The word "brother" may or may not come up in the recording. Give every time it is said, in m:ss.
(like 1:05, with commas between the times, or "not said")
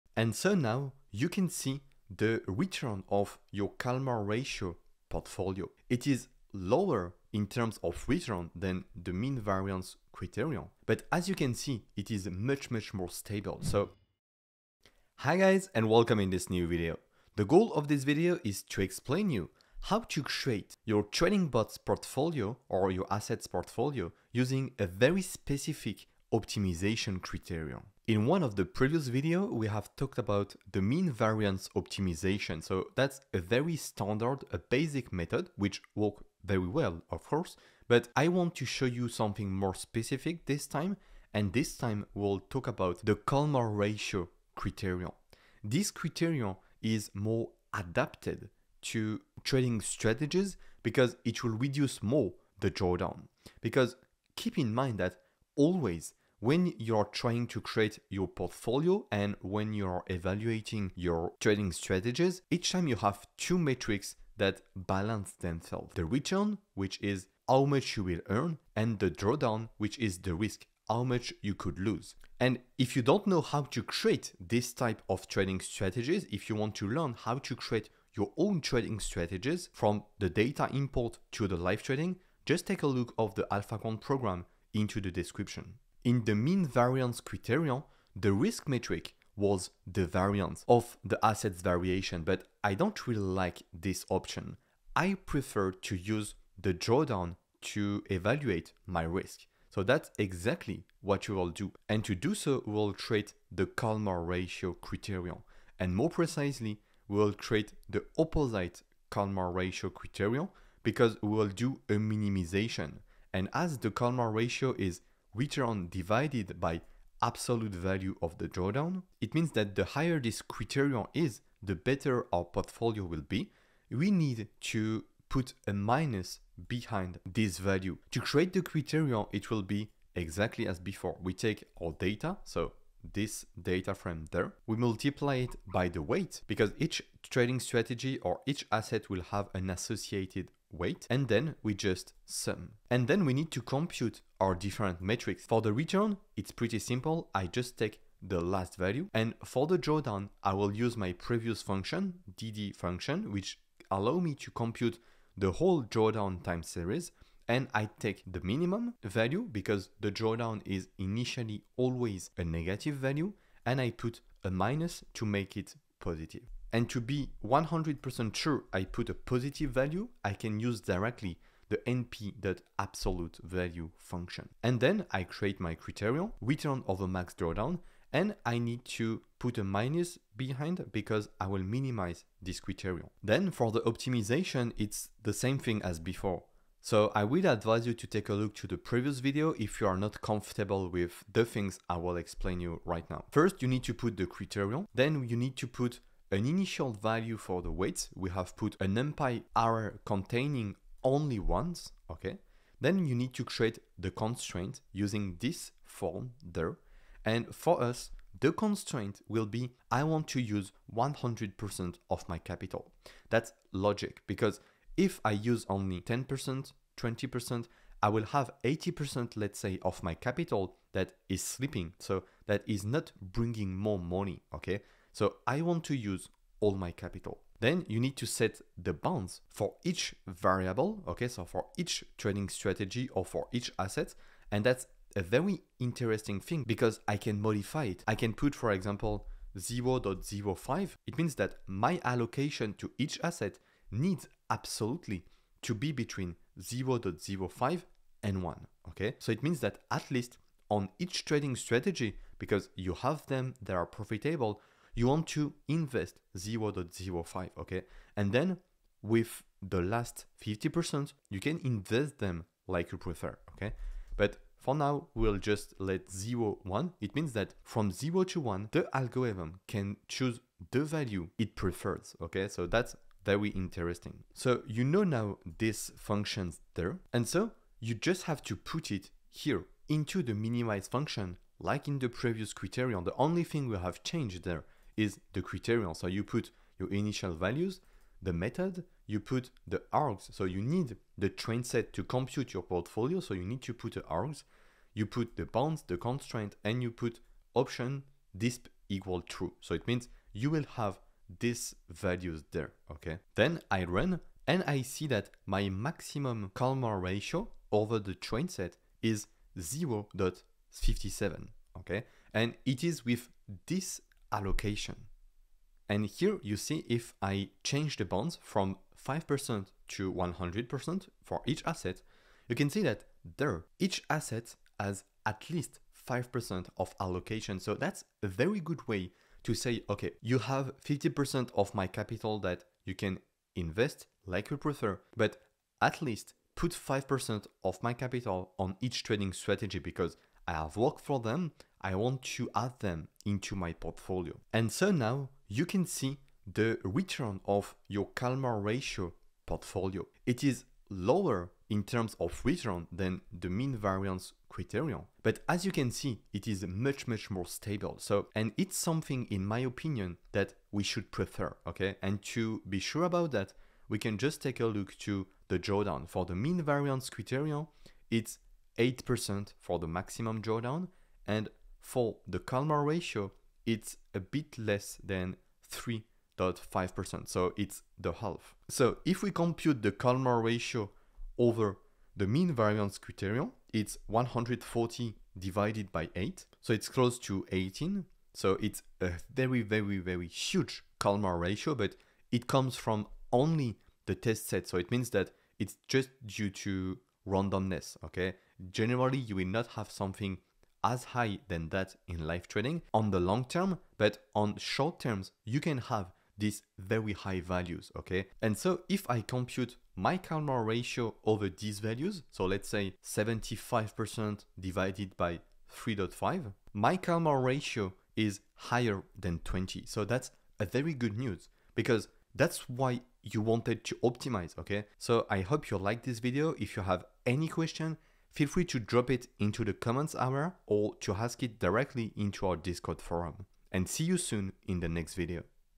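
not said.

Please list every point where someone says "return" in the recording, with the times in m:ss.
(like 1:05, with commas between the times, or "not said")
0:02, 0:08, 1:06, 2:25, 2:56, 5:46, 5:52.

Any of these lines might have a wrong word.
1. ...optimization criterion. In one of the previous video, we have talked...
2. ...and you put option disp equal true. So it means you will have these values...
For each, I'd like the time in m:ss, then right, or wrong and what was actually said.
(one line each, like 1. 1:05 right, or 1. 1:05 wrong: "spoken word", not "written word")
1. 0:26 right
2. 4:56 right.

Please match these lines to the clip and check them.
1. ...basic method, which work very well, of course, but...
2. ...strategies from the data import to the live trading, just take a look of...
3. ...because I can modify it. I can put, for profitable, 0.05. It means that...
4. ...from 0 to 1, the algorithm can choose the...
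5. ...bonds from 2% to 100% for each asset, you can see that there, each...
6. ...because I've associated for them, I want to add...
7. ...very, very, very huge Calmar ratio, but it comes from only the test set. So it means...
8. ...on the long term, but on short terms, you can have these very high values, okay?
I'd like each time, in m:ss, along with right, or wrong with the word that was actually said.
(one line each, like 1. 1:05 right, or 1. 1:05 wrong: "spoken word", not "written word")
1. 0:34 right
2. 1:18 right
3. 3:56 wrong: "example", not "profitable"
4. 4:27 right
5. 5:18 wrong: "5", not "2"
6. 5:39 wrong: "worked", not "associated"
7. 6:29 right
8. 6:42 right.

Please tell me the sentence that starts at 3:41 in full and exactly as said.
So that is not bringing more money, okay?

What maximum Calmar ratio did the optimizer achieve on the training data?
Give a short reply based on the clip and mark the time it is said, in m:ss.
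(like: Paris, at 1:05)
0.57, at 5:09.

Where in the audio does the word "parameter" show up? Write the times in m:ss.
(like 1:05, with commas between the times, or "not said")
not said.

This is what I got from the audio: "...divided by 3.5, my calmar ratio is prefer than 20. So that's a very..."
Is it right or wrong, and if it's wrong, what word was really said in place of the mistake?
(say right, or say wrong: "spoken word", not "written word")
wrong: "higher", not "prefer".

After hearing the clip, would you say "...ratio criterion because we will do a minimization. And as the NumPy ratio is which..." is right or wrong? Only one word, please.
wrong.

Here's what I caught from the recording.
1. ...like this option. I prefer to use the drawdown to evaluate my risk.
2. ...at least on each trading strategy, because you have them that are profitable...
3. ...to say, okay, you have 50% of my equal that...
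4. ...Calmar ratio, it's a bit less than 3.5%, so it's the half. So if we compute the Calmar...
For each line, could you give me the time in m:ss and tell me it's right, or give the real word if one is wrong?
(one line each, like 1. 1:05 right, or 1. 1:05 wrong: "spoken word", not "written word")
1. 1:33 right
2. 4:09 right
3. 5:29 wrong: "capital", not "equal"
4. 6:12 right.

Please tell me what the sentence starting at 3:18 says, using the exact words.
We have put an NumPy array containing only ones, okay?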